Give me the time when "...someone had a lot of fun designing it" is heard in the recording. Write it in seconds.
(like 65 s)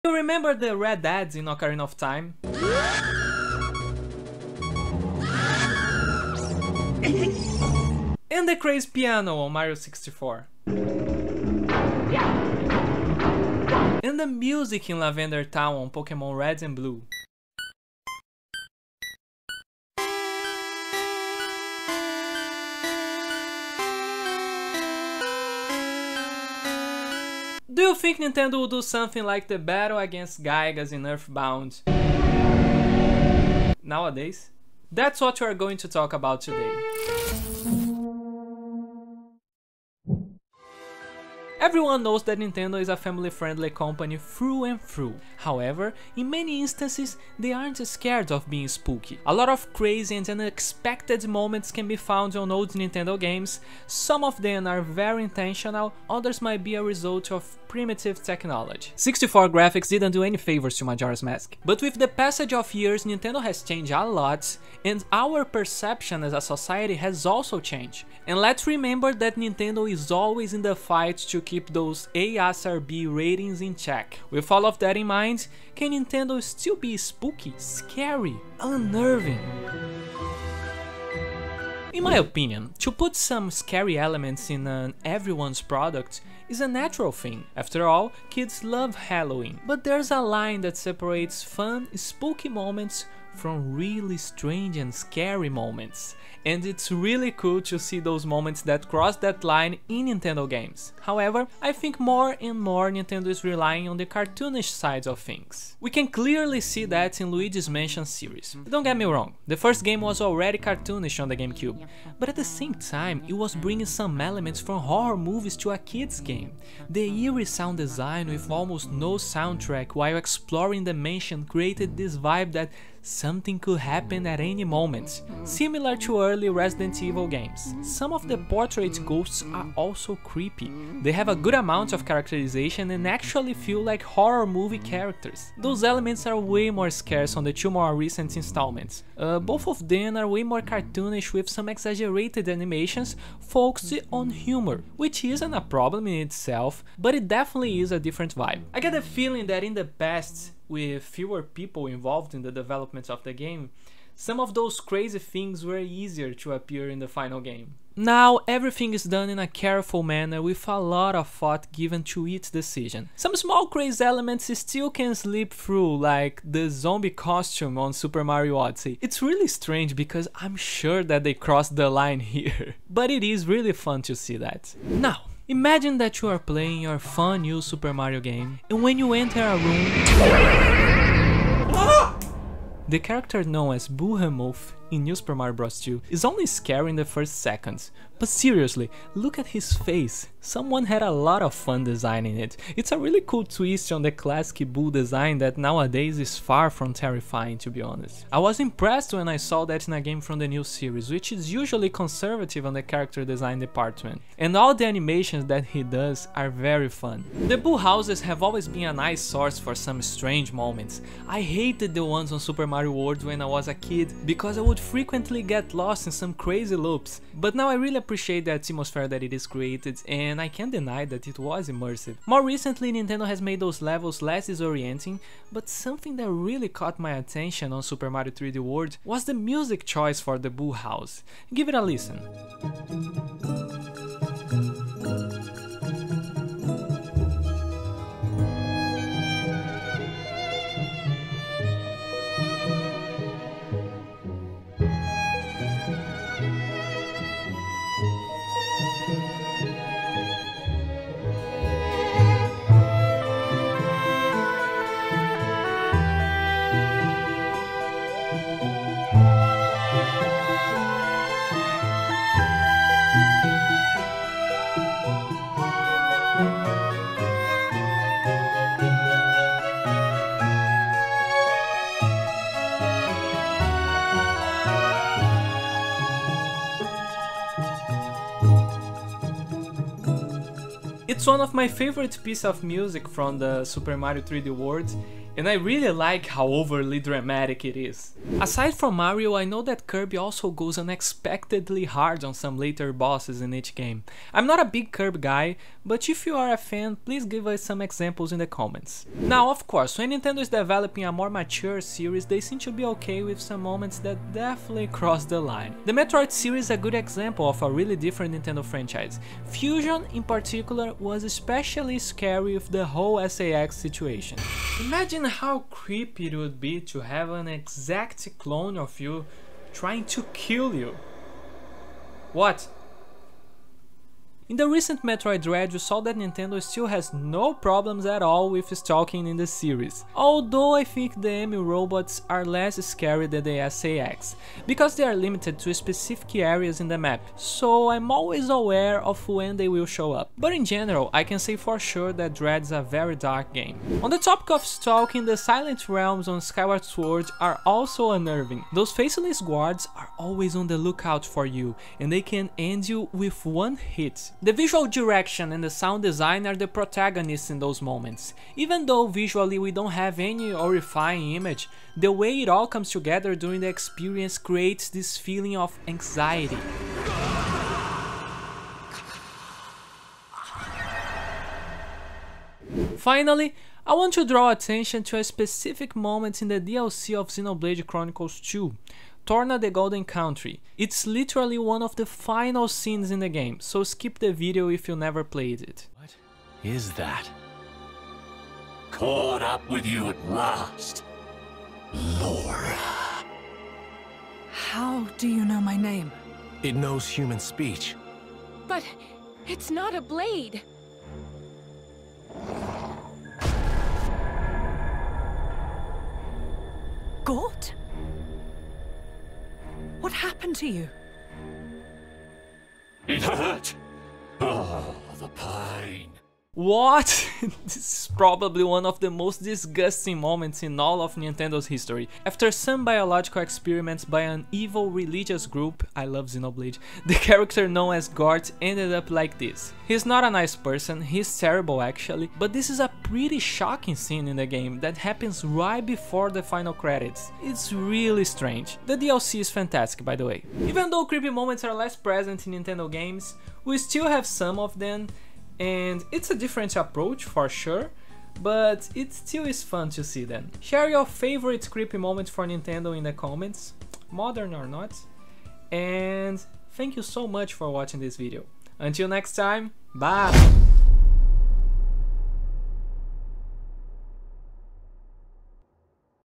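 190 s.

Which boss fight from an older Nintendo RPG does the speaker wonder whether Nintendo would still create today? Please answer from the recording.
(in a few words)
Giygas.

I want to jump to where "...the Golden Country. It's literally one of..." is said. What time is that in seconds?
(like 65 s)
379 s.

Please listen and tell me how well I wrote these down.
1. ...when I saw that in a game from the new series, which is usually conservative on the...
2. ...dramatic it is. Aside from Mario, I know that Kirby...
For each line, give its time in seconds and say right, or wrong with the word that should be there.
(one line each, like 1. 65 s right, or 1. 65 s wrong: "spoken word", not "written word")
1. 199 s right
2. 286 s right.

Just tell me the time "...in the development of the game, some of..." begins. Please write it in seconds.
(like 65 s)
152 s.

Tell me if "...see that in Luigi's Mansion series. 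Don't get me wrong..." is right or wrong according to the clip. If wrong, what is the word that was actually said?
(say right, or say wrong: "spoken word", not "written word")
right.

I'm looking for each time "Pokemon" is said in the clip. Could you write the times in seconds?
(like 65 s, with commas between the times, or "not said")
15 s.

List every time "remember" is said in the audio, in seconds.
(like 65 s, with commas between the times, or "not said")
0 s, 68 s.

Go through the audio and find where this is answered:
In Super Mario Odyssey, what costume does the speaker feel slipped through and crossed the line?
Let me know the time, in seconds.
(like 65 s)
166 s.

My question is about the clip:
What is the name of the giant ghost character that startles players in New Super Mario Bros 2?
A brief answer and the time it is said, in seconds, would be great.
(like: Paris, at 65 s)
Boohemoth, at 183 s.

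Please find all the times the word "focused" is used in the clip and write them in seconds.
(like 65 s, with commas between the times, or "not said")
143 s.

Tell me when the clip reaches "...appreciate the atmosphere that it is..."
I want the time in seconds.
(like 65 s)
217 s.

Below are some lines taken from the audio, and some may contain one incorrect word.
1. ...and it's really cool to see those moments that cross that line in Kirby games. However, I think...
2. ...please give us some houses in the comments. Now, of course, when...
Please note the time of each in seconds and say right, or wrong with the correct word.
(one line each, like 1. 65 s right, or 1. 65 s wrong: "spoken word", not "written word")
1. 96 s wrong: "Nintendo", not "Kirby"
2. 296 s wrong: "examples", not "houses".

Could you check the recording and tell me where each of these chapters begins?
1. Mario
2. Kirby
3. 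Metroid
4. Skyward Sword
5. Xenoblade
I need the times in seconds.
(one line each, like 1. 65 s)
1. 175 s
2. 288 s
3. 300 s
4. 344 s
5. 373 s.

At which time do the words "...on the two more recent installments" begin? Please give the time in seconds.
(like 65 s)
137 s.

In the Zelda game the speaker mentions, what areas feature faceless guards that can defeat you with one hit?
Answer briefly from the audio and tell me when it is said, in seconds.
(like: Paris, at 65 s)
Silent Realms, at 345 s.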